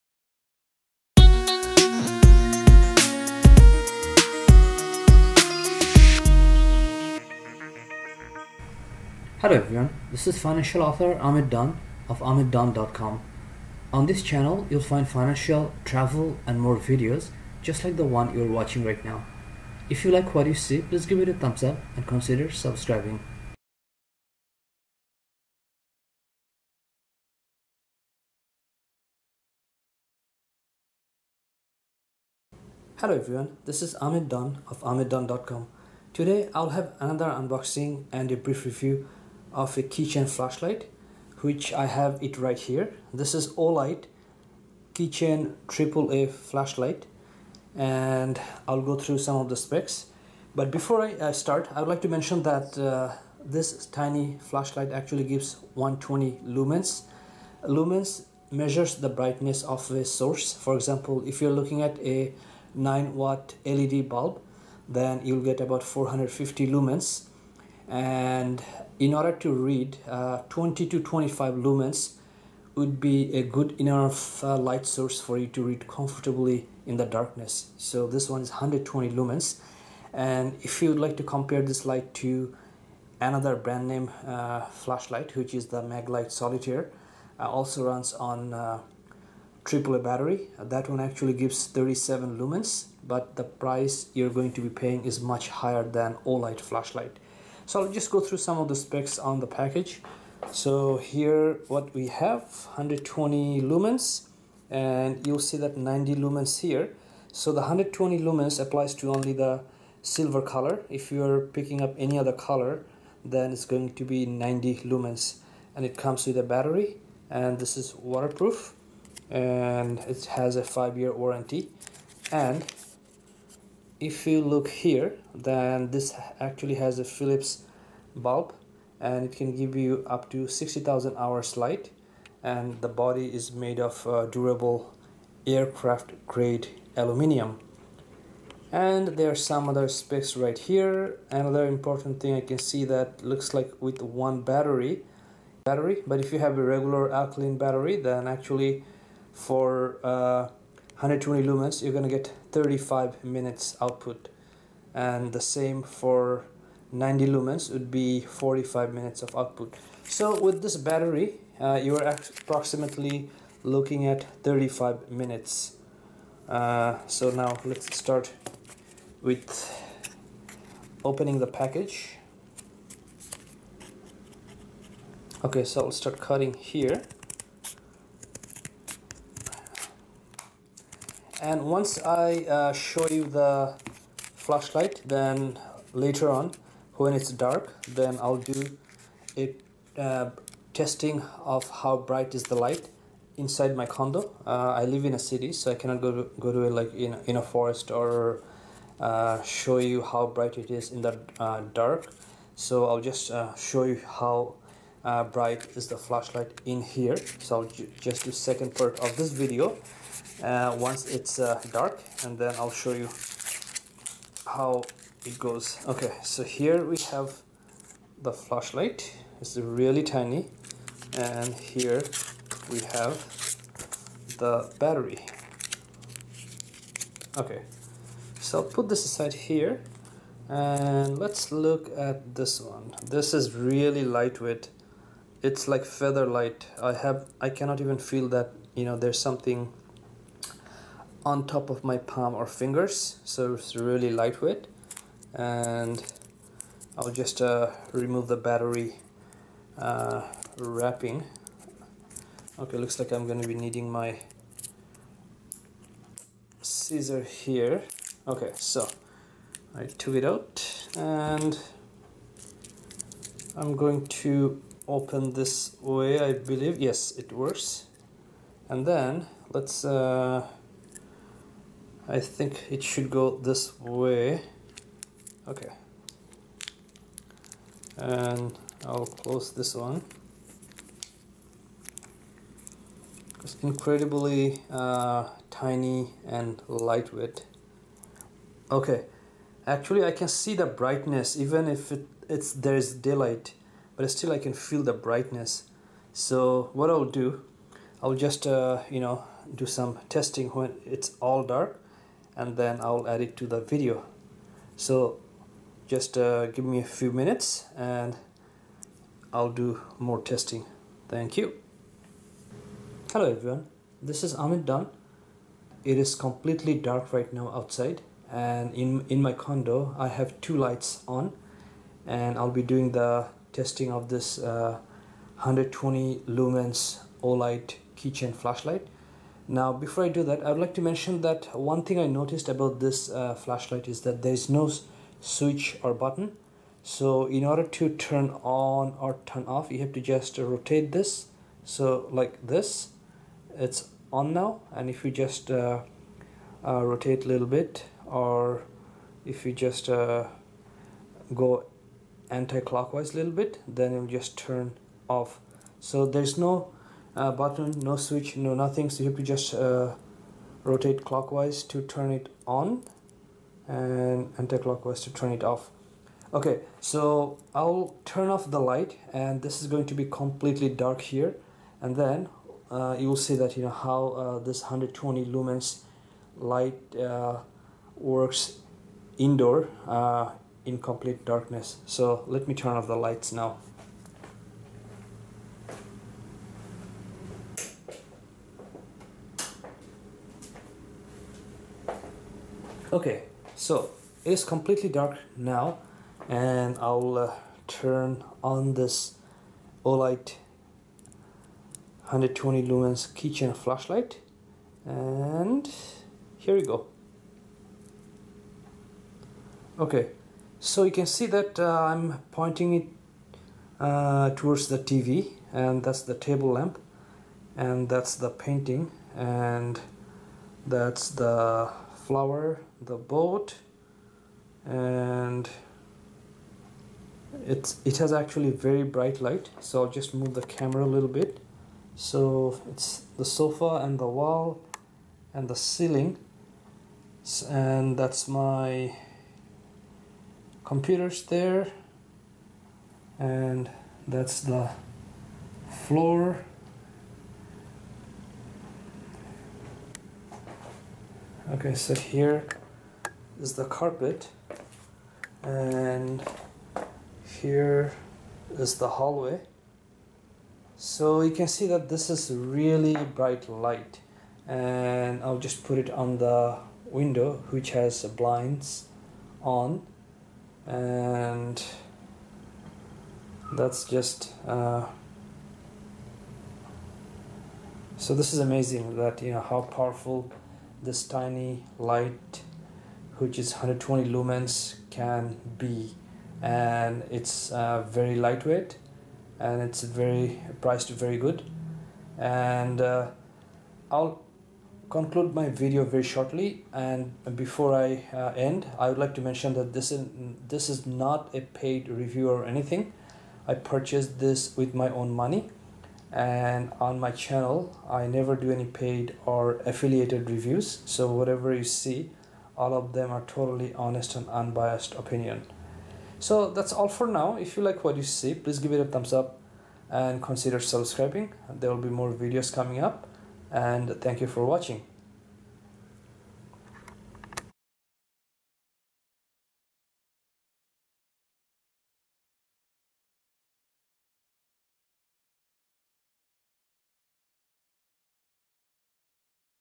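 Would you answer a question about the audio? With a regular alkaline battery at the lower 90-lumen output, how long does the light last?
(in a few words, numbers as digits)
45 minutes.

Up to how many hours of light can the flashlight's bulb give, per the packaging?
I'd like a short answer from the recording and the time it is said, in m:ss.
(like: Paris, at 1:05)
60,000 hours, at 2:10.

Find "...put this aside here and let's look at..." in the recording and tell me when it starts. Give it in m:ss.
3:48.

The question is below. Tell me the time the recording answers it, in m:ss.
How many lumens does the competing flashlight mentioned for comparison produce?
1:31.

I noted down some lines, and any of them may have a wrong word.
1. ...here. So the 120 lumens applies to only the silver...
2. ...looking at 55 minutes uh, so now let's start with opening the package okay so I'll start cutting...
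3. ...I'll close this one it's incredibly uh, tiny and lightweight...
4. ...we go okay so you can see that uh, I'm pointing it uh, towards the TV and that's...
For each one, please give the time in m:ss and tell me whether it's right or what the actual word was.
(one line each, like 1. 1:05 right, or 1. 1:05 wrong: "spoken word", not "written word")
1. 1:46 right
2. 2:43 wrong: "35", not "55"
3. 4:38 right
4. 6:46 right.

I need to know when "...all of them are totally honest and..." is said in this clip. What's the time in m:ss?
8:32.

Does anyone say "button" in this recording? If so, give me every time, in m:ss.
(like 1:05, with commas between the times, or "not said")
5:35, 5:57.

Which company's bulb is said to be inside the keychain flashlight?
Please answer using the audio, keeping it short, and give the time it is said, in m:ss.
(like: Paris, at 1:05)
Philips, at 2:07.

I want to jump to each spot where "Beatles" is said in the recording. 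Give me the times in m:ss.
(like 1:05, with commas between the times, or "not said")
not said.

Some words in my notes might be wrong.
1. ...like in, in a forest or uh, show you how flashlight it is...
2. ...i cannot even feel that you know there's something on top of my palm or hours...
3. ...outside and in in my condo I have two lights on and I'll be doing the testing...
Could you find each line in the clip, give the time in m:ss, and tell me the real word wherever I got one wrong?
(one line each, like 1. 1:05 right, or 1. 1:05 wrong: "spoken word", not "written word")
1. 3:16 wrong: "bright", not "flashlight"
2. 3:57 wrong: "fingers", not "hours"
3. 5:17 right.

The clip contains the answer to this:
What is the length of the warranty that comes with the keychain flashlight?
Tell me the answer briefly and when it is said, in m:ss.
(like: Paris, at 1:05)
5 years, at 2:00.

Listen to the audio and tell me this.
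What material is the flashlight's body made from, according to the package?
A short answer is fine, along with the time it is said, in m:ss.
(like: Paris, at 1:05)
aircraft grade aluminium, at 2:15.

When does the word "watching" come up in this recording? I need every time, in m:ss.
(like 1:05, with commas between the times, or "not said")
0:18, 8:44.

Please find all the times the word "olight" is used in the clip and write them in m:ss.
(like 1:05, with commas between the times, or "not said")
0:43, 1:36, 5:27, 6:39.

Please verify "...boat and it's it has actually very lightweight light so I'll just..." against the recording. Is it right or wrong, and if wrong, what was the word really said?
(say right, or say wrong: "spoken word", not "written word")
wrong: "bright", not "lightweight".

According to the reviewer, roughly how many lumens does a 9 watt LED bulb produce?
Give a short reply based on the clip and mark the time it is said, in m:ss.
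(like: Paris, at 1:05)
450, at 1:05.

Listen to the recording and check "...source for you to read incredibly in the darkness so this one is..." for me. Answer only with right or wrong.
wrong.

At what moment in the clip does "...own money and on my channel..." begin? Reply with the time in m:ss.
8:24.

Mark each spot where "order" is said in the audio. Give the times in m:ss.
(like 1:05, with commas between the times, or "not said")
1:09, 5:37.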